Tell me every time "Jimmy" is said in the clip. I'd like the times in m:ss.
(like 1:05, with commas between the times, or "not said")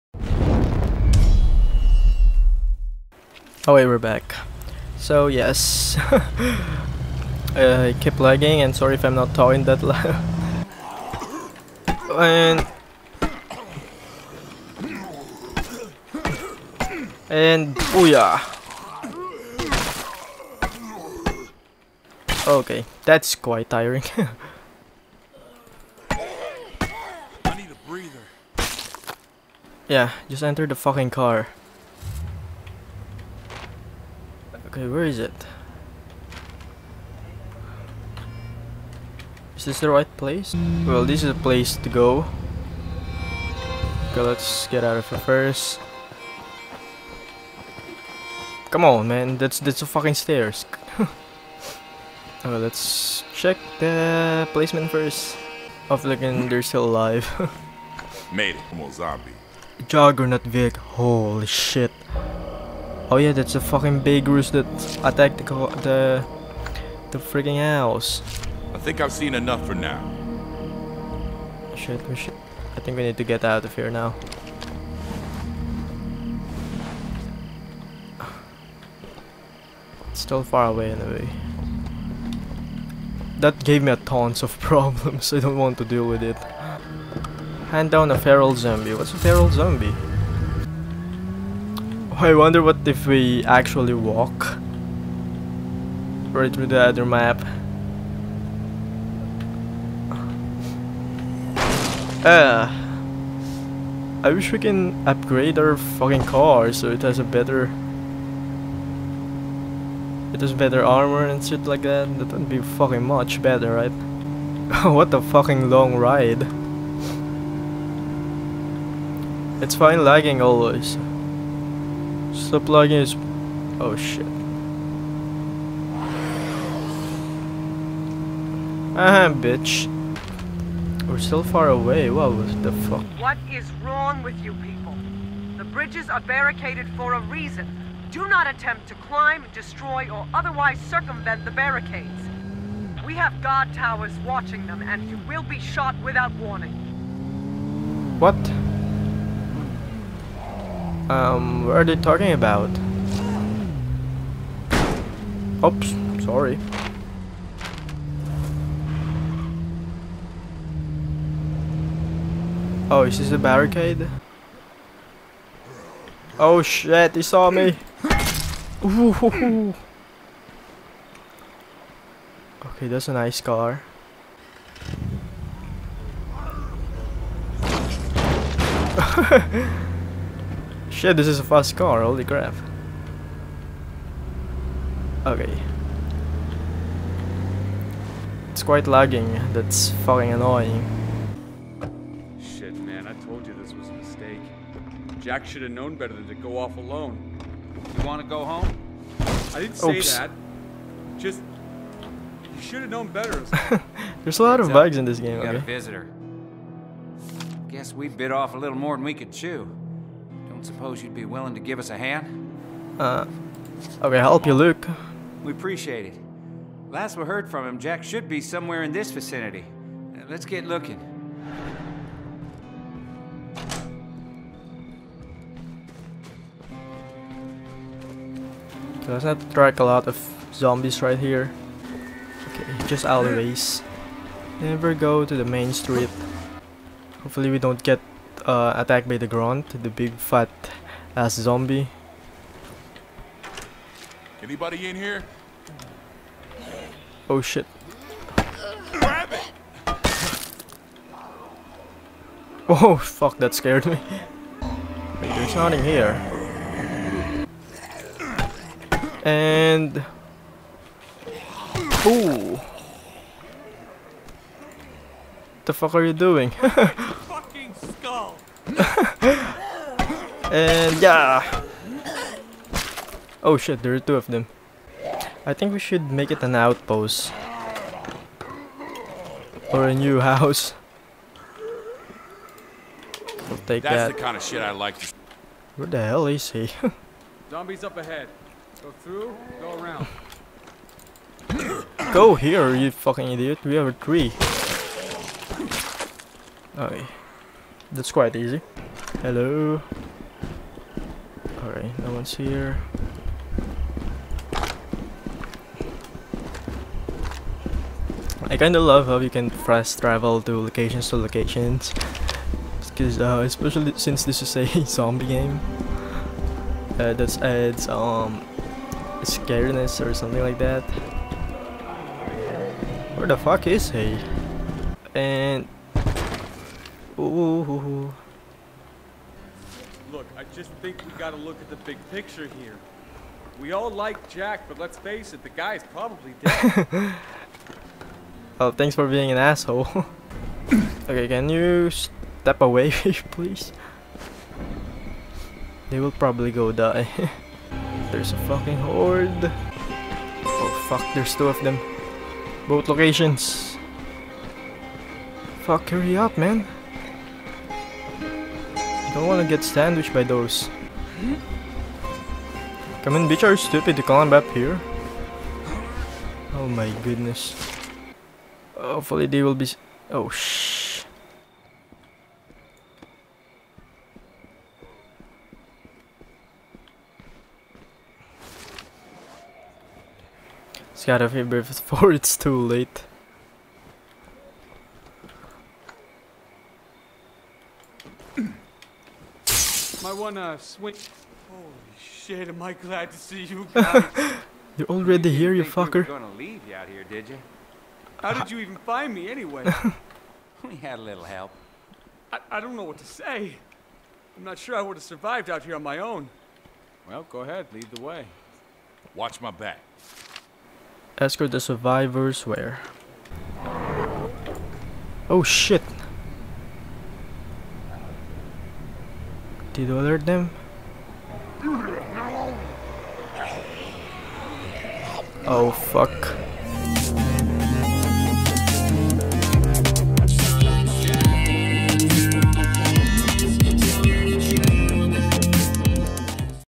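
not said.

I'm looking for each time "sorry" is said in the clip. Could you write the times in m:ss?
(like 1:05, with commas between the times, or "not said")
0:08, 2:36.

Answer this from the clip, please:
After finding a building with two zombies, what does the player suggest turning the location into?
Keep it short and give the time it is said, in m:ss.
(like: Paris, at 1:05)
An outpost, at 4:36.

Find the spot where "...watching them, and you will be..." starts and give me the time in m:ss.
2:24.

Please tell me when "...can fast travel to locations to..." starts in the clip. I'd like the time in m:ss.
5:09.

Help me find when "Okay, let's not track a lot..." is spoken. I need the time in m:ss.
3:48.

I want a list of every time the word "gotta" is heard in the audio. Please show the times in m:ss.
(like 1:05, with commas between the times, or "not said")
5:31, 6:21.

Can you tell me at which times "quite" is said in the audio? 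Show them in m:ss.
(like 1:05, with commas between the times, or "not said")
0:23, 3:08, 4:58.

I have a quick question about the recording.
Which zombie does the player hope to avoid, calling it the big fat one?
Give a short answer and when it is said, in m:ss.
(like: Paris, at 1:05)
The grunt, at 3:59.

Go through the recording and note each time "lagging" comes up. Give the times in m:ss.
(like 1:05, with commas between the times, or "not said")
0:08, 2:00, 3:08.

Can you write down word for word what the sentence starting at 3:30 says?
Suppose you'd be willing to give us a hand?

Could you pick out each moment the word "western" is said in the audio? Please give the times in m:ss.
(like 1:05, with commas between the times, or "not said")
not said.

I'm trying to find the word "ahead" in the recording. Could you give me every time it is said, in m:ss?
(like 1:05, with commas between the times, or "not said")
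4:47, 6:47.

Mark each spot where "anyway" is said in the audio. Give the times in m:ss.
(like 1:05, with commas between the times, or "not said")
1:20, 6:39.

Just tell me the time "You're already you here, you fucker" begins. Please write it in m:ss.
6:34.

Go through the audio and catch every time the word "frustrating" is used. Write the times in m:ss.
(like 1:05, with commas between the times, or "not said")
not said.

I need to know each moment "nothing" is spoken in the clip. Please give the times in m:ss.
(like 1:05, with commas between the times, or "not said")
4:15.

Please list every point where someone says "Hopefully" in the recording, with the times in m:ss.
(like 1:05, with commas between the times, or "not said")
3:57, 6:08.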